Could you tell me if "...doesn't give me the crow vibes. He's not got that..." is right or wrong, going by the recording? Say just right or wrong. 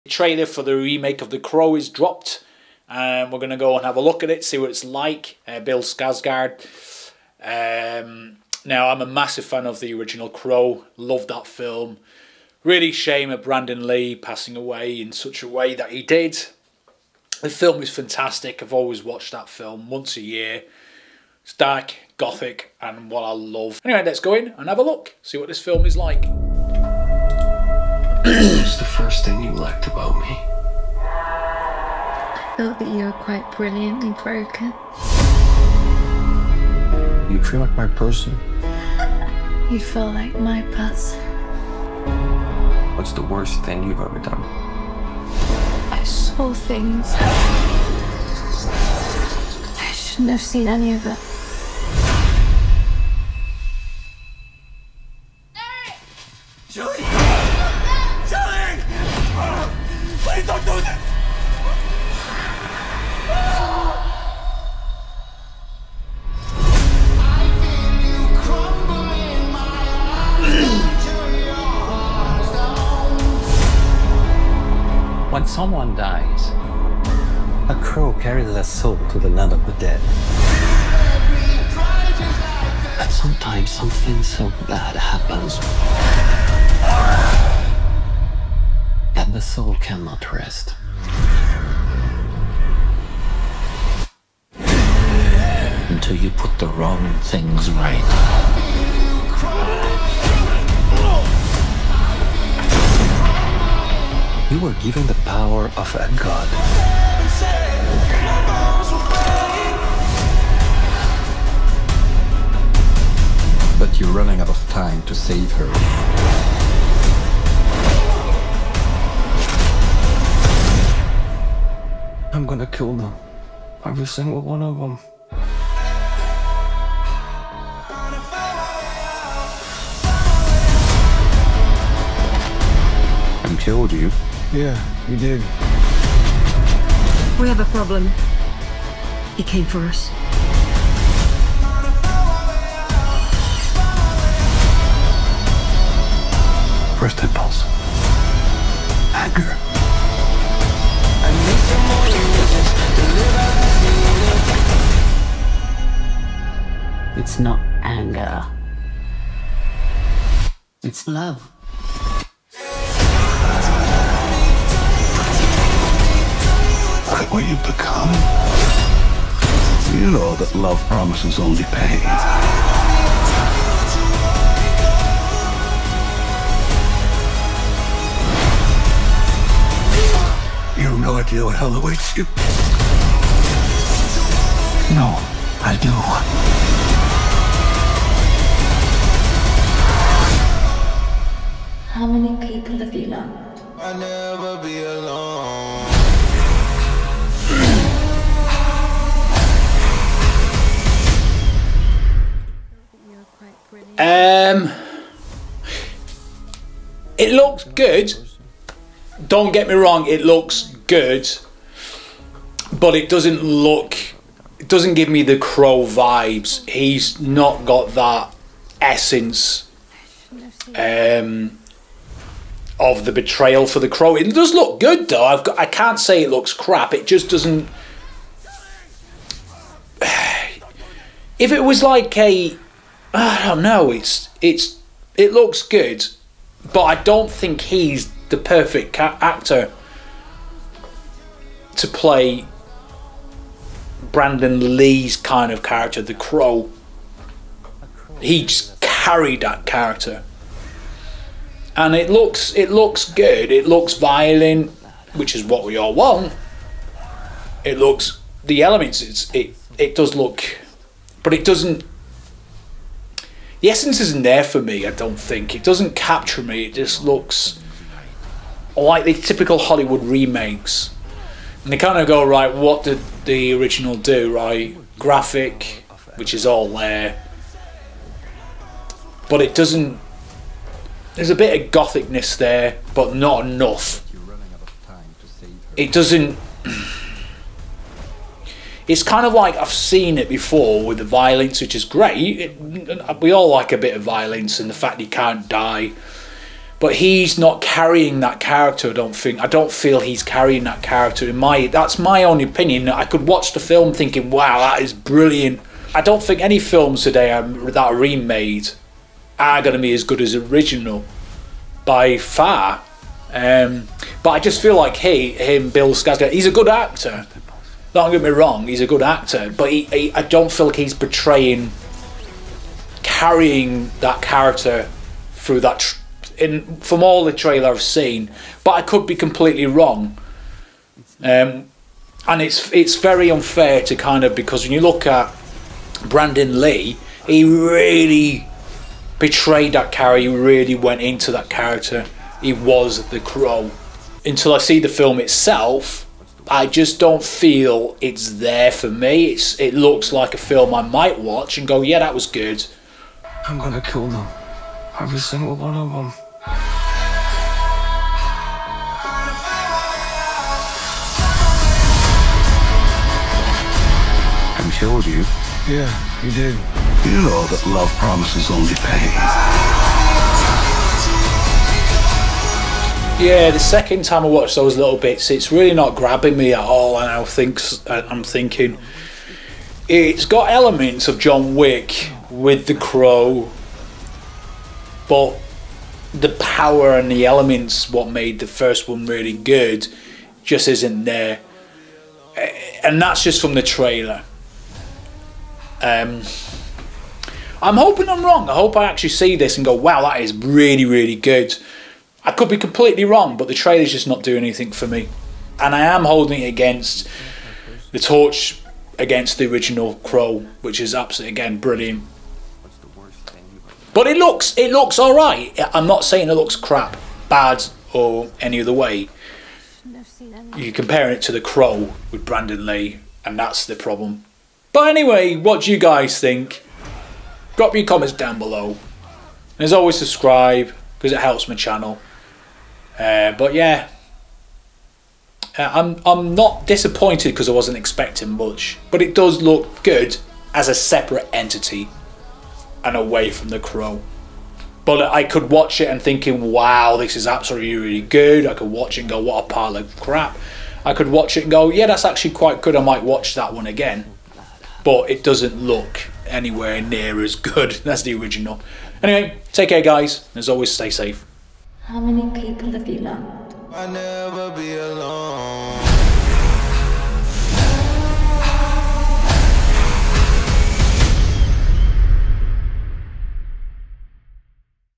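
right.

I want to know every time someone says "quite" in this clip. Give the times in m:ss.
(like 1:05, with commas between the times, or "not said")
0:33, 7:32.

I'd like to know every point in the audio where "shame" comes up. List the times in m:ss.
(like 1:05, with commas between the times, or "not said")
0:12.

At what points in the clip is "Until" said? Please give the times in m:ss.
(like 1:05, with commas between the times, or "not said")
1:35, 5:44.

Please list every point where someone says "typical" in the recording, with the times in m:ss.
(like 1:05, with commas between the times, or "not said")
4:29.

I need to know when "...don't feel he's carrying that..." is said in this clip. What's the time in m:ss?
4:59.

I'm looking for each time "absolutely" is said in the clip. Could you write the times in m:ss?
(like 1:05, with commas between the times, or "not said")
6:50, 7:27.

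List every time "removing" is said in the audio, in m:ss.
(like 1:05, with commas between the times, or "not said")
not said.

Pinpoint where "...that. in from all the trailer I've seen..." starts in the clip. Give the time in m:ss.
5:25.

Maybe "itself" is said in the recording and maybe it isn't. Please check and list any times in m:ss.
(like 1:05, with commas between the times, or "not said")
5:45.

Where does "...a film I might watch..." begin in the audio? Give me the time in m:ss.
5:50.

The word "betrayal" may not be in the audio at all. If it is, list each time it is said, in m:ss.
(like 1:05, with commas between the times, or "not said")
3:43.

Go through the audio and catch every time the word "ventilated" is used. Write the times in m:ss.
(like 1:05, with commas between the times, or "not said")
not said.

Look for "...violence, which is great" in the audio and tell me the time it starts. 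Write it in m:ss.
4:51.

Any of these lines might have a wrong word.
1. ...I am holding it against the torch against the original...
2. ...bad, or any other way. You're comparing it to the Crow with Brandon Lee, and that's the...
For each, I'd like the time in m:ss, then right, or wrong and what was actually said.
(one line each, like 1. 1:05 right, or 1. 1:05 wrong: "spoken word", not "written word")
1. 6:45 right
2. 6:57 right.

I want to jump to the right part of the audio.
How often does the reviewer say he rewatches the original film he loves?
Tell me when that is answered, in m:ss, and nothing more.
0:19.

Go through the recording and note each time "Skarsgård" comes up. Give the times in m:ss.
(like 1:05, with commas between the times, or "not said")
0:05, 5:15.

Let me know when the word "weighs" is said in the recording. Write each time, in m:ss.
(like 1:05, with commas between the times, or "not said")
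not said.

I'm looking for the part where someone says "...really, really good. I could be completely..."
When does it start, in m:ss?
6:40.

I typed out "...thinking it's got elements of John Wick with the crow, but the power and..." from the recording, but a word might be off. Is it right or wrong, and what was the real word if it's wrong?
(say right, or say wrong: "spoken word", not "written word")
right.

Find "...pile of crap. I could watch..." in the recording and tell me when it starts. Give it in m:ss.
7:29.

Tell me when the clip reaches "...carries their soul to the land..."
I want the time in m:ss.
1:18.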